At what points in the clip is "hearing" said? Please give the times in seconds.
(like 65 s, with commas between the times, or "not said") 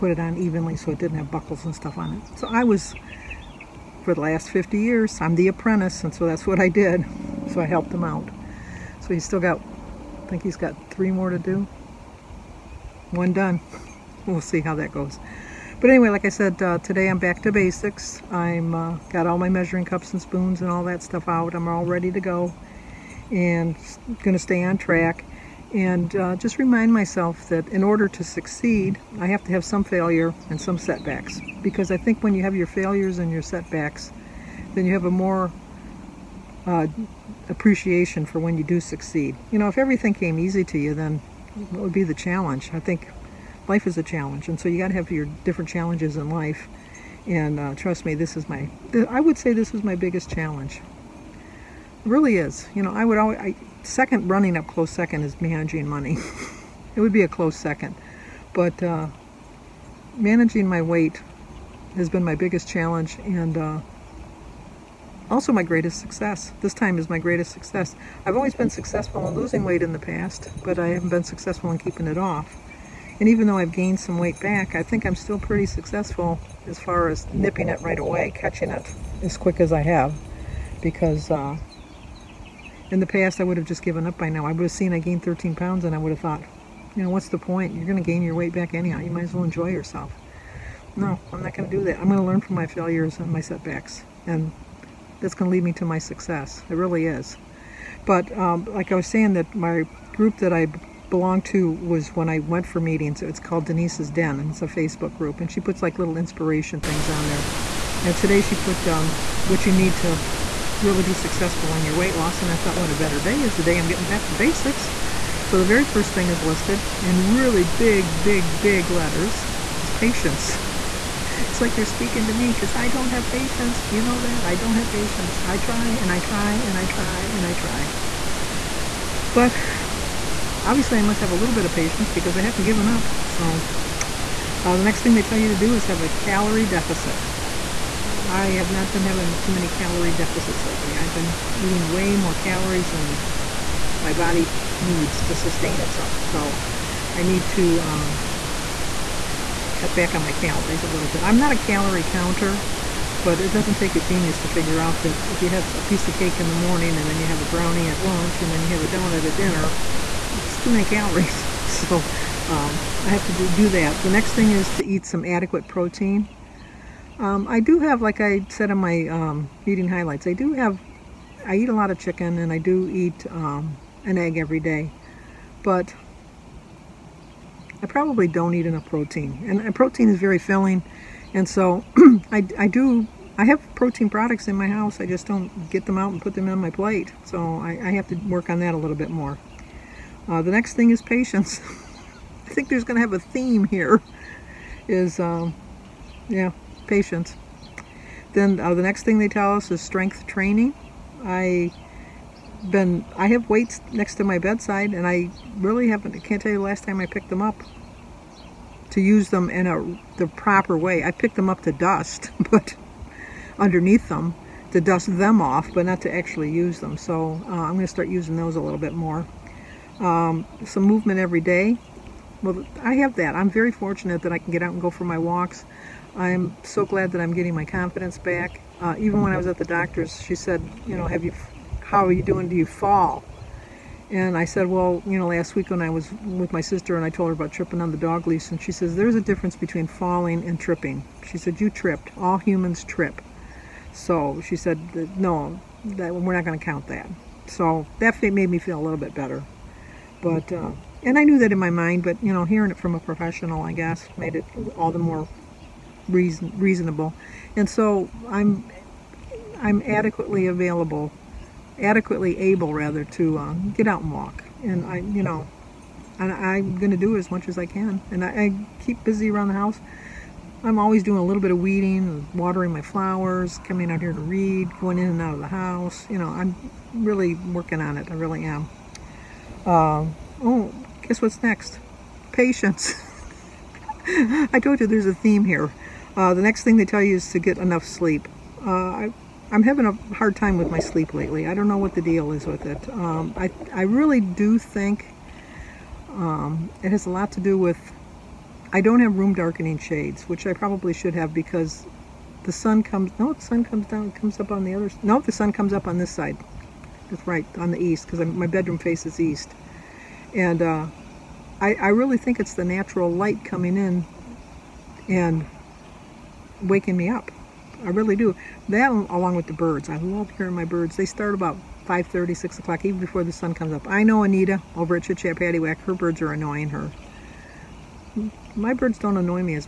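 252 s, 320 s.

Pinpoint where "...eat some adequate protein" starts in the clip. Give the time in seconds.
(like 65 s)
164 s.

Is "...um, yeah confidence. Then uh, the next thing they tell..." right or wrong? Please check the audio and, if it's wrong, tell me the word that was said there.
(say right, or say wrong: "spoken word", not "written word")
wrong: "patience", not "confidence".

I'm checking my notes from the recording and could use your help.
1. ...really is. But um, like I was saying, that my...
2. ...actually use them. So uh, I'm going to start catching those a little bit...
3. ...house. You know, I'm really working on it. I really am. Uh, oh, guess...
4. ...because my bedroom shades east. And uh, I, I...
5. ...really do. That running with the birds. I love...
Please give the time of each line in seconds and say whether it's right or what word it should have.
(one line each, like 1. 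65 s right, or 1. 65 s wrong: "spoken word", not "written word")
1. 96 s right
2. 216 s wrong: "using", not "catching"
3. 275 s right
4. 308 s wrong: "faces", not "shades"
5. 317 s wrong: "along", not "running".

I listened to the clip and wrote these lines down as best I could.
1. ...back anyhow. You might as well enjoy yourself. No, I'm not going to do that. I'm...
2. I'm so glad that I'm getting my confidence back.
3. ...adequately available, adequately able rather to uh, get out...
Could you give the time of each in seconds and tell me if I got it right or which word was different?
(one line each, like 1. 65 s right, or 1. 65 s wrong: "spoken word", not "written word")
1. 88 s right
2. 226 s right
3. 259 s right.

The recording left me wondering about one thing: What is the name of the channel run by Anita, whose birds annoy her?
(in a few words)
Chat Paddywhack.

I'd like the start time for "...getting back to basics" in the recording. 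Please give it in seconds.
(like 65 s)
113 s.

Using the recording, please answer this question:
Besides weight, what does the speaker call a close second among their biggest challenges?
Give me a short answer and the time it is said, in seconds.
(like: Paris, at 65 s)
Managing money, at 55 s.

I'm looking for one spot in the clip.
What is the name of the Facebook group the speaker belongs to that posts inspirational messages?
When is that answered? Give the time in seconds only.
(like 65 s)
103 s.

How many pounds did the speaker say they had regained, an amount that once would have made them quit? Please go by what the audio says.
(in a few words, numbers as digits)
13.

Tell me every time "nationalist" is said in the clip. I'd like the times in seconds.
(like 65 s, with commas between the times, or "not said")
not said.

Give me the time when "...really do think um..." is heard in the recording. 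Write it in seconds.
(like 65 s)
293 s.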